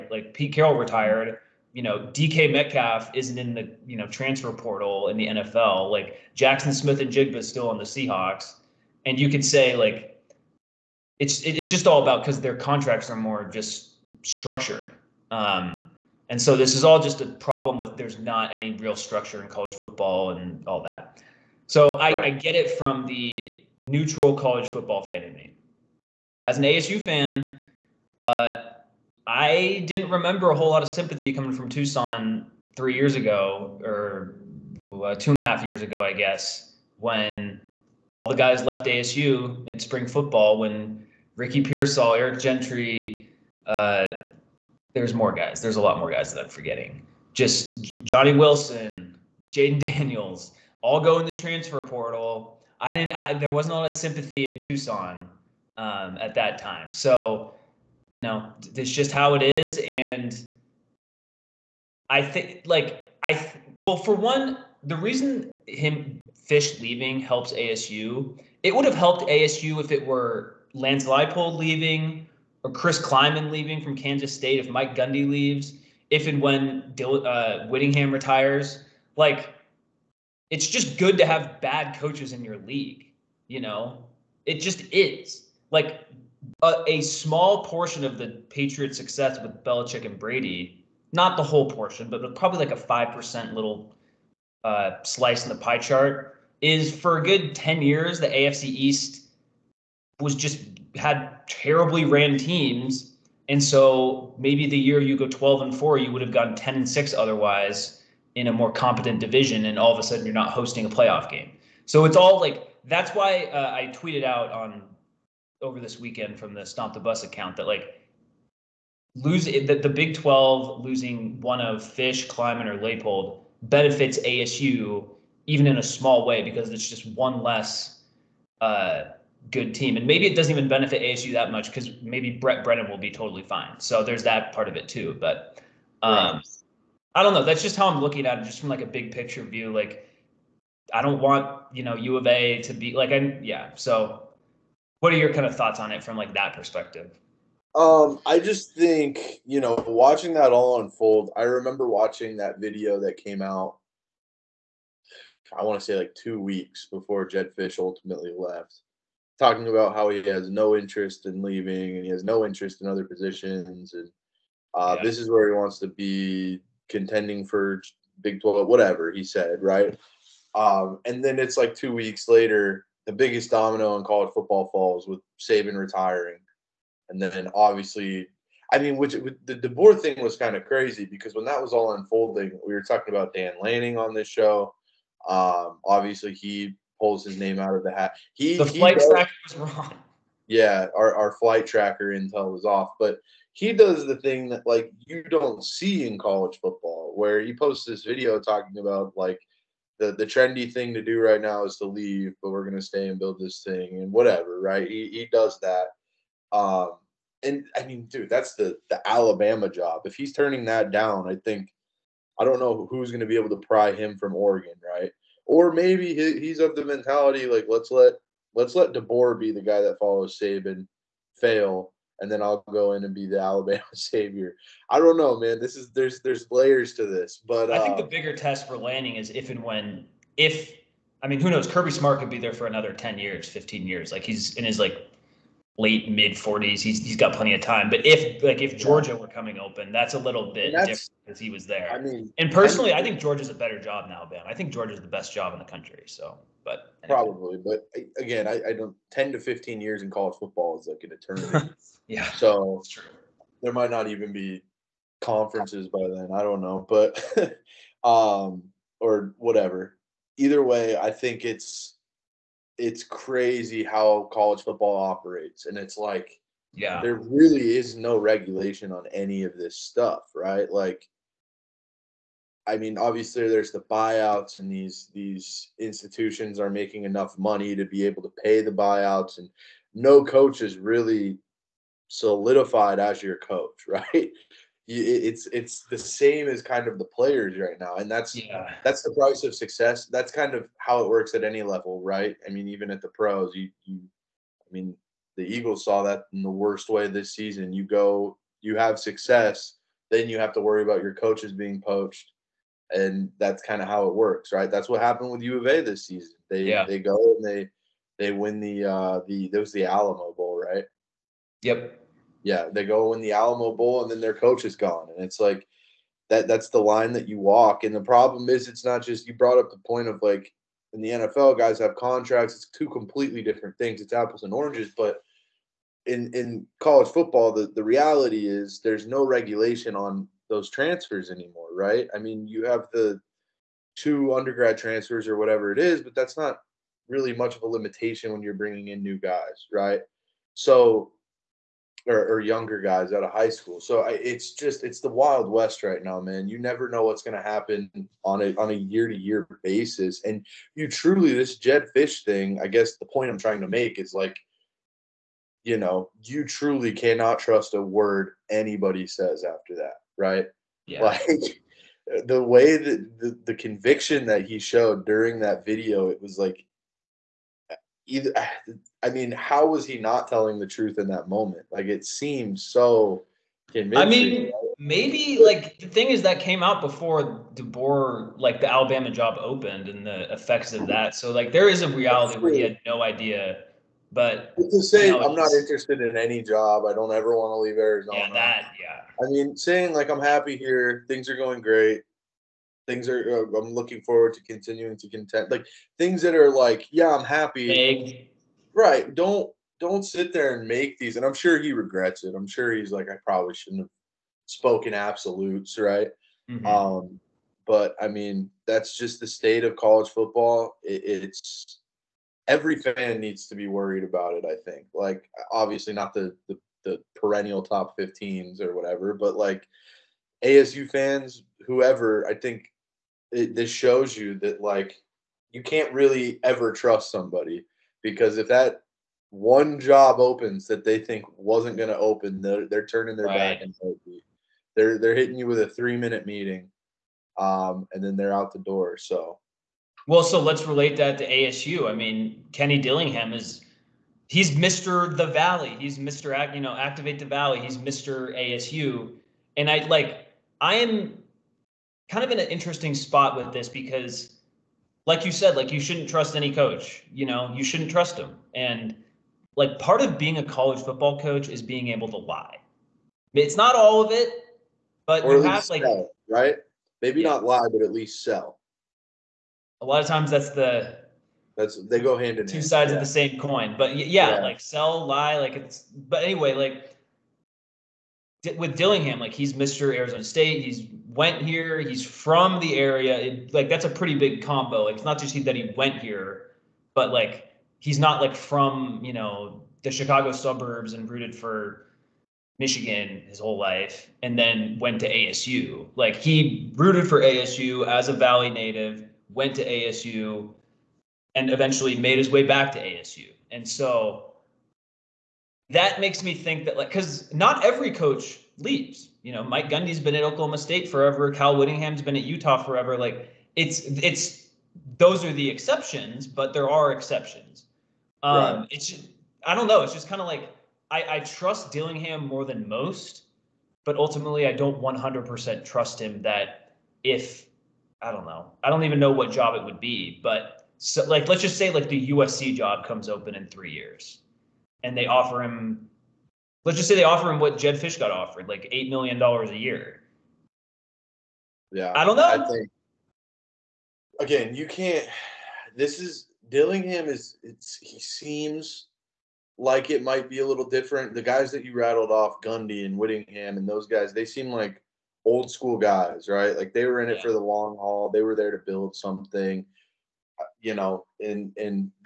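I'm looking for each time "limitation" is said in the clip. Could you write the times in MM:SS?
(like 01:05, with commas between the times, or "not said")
05:37.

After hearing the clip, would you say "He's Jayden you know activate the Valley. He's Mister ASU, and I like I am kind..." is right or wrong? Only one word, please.
wrong.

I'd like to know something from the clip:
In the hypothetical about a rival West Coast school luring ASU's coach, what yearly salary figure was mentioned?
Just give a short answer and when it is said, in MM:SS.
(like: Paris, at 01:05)
8 million dollars, at 08:58.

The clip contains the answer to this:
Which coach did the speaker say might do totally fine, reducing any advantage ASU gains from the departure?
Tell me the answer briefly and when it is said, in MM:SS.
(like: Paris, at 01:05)
Brent Brennan, at 02:12.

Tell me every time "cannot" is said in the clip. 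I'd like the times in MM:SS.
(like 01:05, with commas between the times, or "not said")
05:56.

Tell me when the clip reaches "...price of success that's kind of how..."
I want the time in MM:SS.
04:49.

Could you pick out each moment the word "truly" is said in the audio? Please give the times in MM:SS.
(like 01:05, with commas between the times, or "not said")
05:50, 05:56.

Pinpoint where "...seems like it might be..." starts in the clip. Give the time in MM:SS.
09:07.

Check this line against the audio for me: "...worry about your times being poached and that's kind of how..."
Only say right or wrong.
wrong.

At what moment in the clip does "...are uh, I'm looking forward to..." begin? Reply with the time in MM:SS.
06:33.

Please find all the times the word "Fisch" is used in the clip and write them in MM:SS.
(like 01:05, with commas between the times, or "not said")
01:06, 02:01, 02:37, 05:51, 08:57.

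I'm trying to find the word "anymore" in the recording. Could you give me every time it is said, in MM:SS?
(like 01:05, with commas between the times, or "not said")
05:31.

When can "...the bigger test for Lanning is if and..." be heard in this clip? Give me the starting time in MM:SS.
03:48.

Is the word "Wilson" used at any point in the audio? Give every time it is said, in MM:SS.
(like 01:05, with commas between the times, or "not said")
00:48.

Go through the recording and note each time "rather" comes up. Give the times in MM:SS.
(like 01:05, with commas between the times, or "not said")
not said.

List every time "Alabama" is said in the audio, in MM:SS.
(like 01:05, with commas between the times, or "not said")
03:29, 03:43, 06:18.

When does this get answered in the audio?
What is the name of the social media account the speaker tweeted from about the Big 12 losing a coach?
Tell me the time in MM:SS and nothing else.
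01:56.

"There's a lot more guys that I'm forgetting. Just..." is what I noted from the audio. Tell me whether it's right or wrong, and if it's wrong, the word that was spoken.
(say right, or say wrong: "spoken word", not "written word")
right.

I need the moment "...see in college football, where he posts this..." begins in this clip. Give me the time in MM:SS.
03:15.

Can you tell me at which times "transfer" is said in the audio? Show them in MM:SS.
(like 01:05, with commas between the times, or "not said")
00:04, 00:51, 05:30, 05:34.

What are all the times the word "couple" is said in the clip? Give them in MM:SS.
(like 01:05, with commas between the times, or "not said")
not said.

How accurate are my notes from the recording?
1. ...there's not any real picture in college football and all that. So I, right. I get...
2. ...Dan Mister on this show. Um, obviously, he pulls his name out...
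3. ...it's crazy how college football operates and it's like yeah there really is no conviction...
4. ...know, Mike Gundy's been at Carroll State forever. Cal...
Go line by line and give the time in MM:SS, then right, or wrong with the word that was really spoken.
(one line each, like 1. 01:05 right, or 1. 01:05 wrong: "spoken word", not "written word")
1. 00:17 wrong: "structure", not "picture"
2. 03:03 wrong: "Lanning", not "Mister"
3. 04:22 wrong: "regulation", not "conviction"
4. 08:29 wrong: "Oklahoma", not "Carroll".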